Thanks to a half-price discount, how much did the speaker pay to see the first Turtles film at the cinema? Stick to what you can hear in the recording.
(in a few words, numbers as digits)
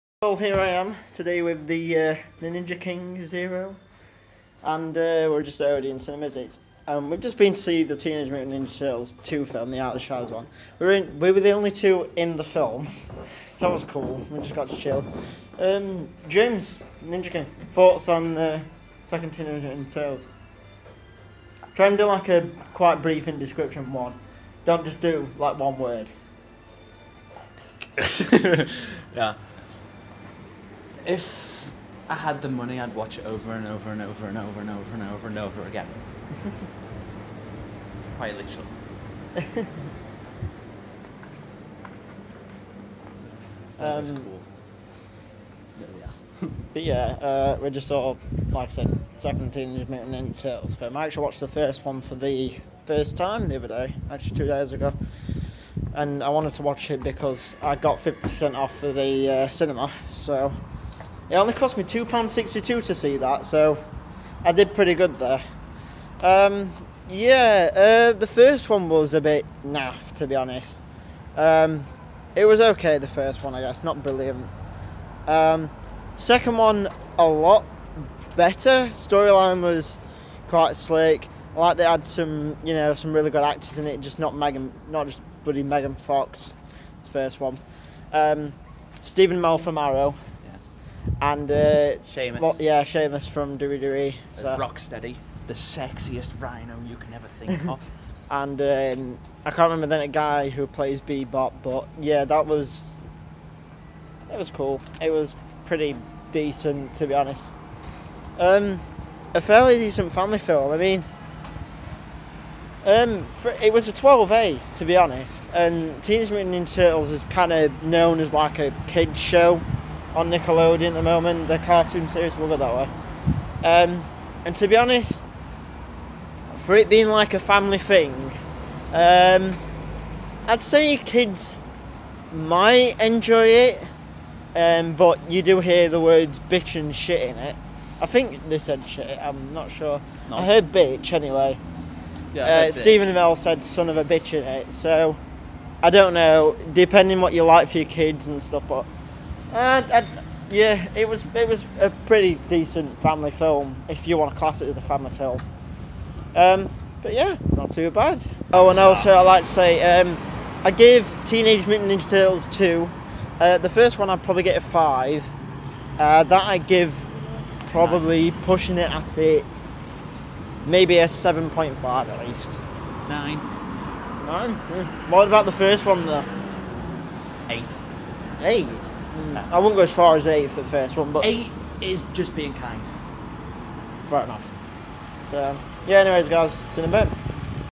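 £2.62.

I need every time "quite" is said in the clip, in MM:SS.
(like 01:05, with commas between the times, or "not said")
00:22, 00:38, 01:20.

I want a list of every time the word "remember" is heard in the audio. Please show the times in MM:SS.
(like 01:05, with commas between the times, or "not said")
01:39.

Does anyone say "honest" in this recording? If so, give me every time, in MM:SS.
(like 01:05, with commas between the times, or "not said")
01:10, 01:47, 01:54, 02:04.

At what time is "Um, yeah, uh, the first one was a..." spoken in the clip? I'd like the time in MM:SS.
01:06.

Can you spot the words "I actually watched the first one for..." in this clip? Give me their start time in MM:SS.
00:50.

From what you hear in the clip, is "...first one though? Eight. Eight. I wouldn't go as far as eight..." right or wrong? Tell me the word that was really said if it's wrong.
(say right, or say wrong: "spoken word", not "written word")
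right.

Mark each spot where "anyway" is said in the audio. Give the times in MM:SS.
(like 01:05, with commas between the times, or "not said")
02:21, 03:05.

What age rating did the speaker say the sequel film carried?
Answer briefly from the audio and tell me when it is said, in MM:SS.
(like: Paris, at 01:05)
12A, at 01:53.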